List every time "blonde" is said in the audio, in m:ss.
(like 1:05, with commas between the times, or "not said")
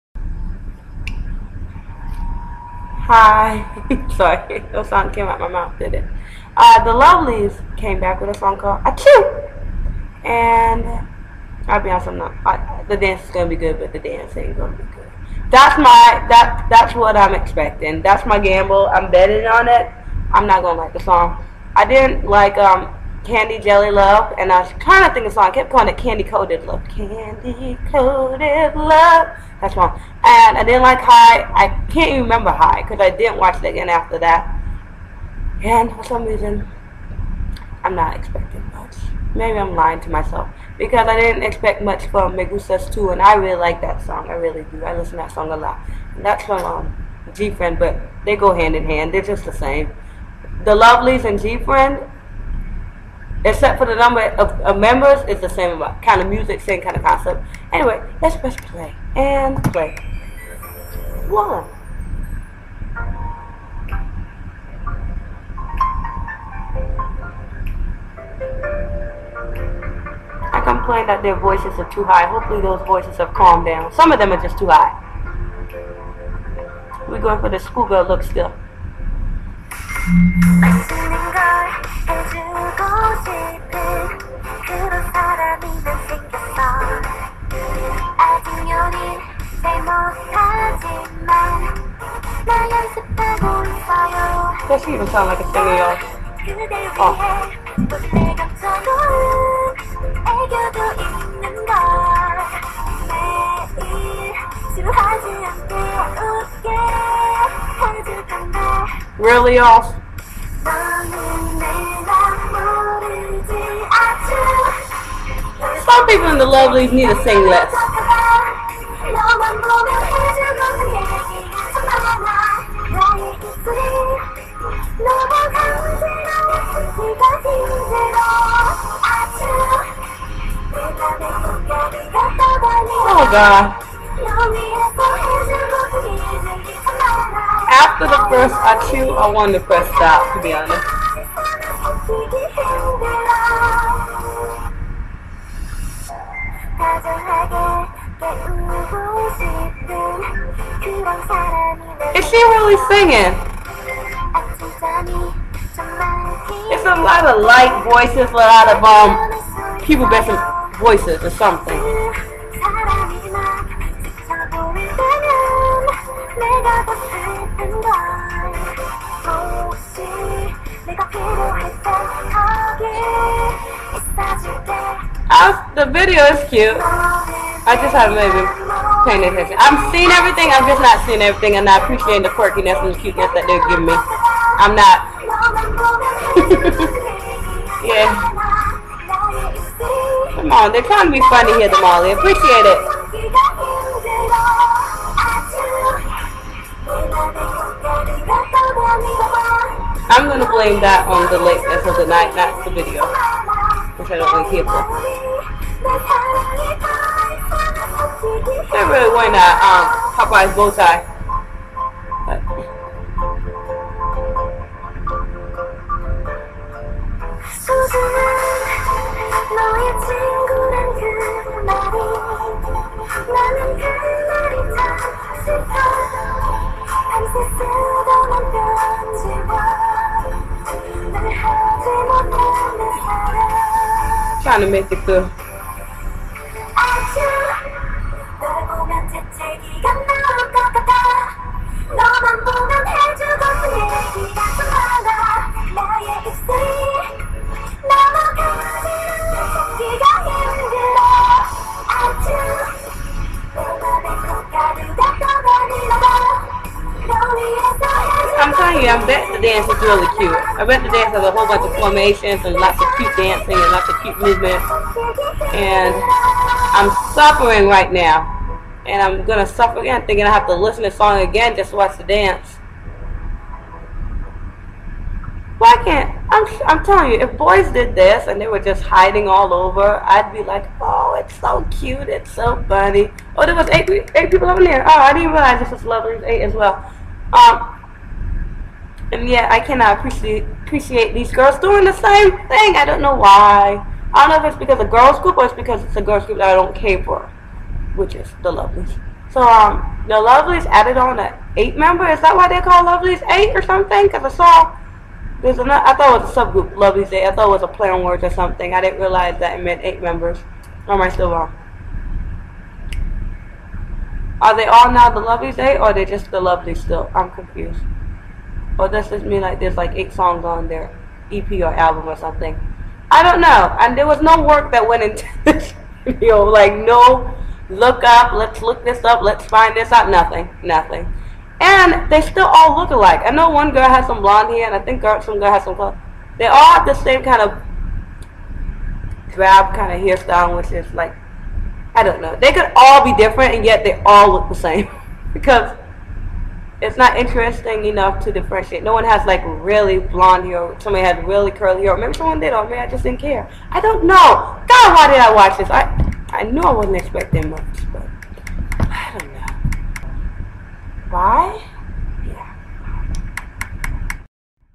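5:34, 5:49.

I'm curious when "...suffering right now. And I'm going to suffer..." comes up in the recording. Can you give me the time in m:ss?
4:27.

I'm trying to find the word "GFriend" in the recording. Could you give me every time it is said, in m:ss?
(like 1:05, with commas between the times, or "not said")
0:47, 0:51.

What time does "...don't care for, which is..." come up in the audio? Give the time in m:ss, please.
4:56.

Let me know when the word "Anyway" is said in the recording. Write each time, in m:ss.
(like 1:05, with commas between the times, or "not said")
0:57.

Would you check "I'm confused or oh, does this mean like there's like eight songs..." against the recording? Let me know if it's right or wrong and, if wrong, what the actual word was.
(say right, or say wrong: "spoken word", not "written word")
right.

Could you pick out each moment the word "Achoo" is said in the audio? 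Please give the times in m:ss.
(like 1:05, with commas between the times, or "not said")
0:08.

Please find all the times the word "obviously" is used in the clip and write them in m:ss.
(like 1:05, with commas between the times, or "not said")
not said.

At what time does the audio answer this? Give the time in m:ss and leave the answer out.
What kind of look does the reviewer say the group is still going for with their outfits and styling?
1:17.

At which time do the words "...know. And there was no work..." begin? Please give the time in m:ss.
5:23.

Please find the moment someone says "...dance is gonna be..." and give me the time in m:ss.
0:12.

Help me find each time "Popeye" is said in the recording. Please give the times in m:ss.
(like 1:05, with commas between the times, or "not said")
3:30.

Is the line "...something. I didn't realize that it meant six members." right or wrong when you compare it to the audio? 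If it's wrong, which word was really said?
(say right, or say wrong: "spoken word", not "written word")
wrong: "eight", not "six".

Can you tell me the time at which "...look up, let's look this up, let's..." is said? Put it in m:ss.
5:27.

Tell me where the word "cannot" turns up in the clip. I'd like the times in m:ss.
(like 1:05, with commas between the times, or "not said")
4:49.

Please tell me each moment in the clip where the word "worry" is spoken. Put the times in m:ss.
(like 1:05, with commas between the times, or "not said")
not said.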